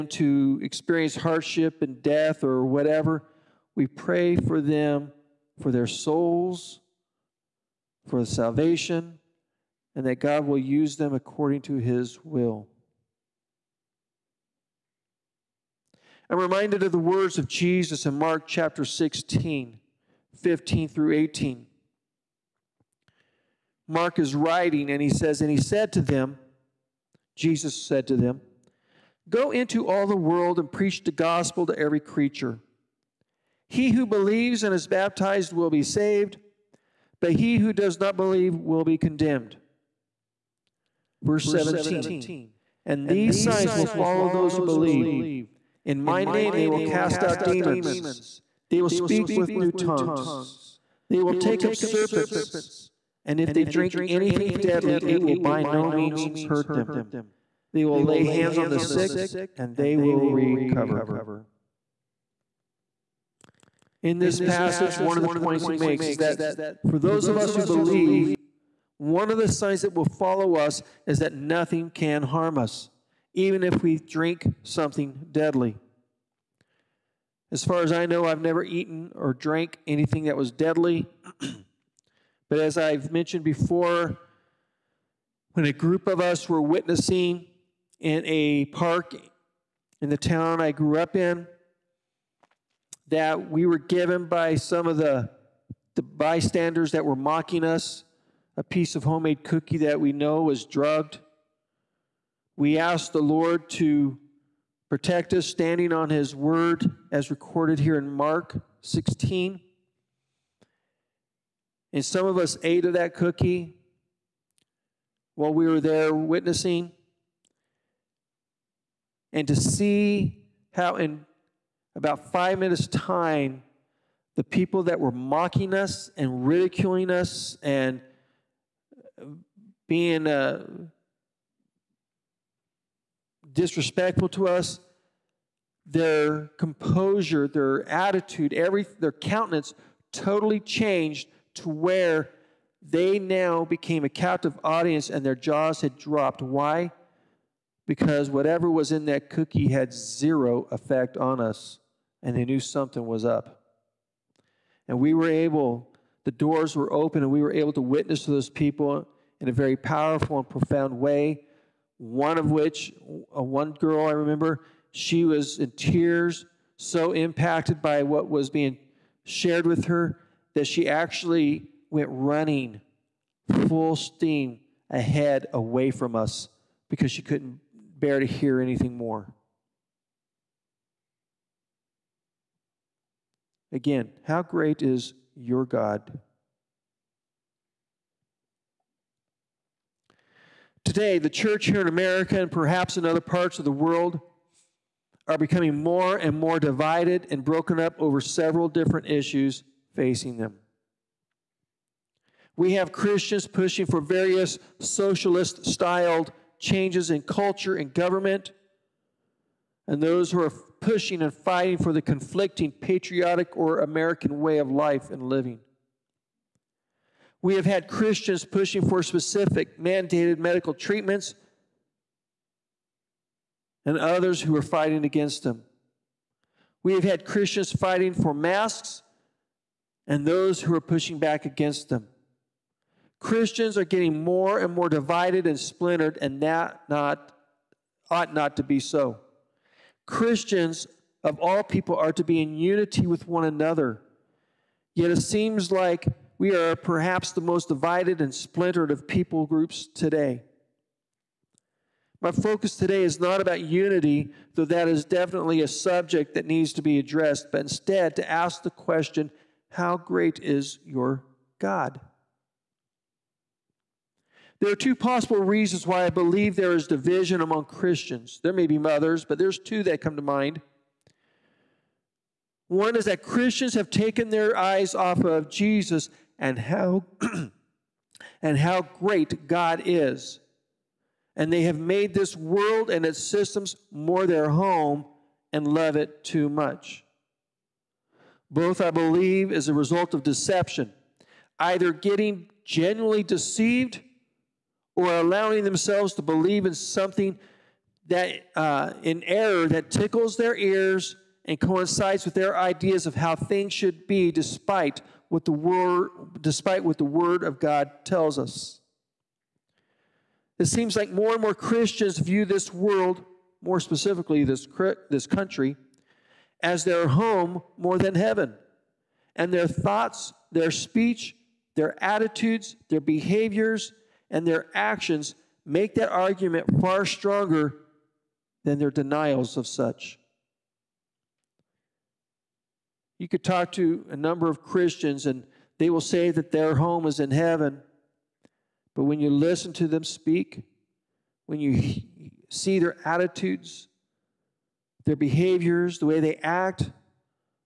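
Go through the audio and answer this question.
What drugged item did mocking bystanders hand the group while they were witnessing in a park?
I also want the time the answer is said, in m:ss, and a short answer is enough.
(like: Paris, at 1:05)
Homemade cookie, at 1:39.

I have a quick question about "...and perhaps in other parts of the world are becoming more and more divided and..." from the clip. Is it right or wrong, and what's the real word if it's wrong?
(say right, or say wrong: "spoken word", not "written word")
right.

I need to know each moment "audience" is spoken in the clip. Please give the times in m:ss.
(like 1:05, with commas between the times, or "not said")
2:24.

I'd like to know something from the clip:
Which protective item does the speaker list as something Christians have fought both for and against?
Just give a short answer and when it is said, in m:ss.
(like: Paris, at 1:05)
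Masks, at 3:48.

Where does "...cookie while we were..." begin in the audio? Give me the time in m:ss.
1:53.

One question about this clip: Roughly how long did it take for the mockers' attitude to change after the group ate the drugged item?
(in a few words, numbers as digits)
5 minutes.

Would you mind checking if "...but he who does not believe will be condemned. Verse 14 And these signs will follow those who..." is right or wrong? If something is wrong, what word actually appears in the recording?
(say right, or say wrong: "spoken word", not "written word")
wrong: "17", not "14".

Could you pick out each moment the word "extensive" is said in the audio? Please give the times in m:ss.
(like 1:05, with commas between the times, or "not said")
not said.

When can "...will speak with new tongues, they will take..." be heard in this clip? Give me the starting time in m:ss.
0:48.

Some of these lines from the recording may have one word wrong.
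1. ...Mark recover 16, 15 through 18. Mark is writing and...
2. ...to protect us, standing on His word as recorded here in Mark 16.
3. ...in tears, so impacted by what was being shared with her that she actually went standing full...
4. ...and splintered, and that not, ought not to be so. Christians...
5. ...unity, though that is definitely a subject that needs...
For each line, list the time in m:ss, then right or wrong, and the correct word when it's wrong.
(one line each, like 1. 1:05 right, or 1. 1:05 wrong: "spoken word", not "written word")
1. 0:18 wrong: "chapter", not "recover"
2. 1:43 right
3. 2:45 wrong: "running", not "standing"
4. 3:55 right
5. 4:13 right.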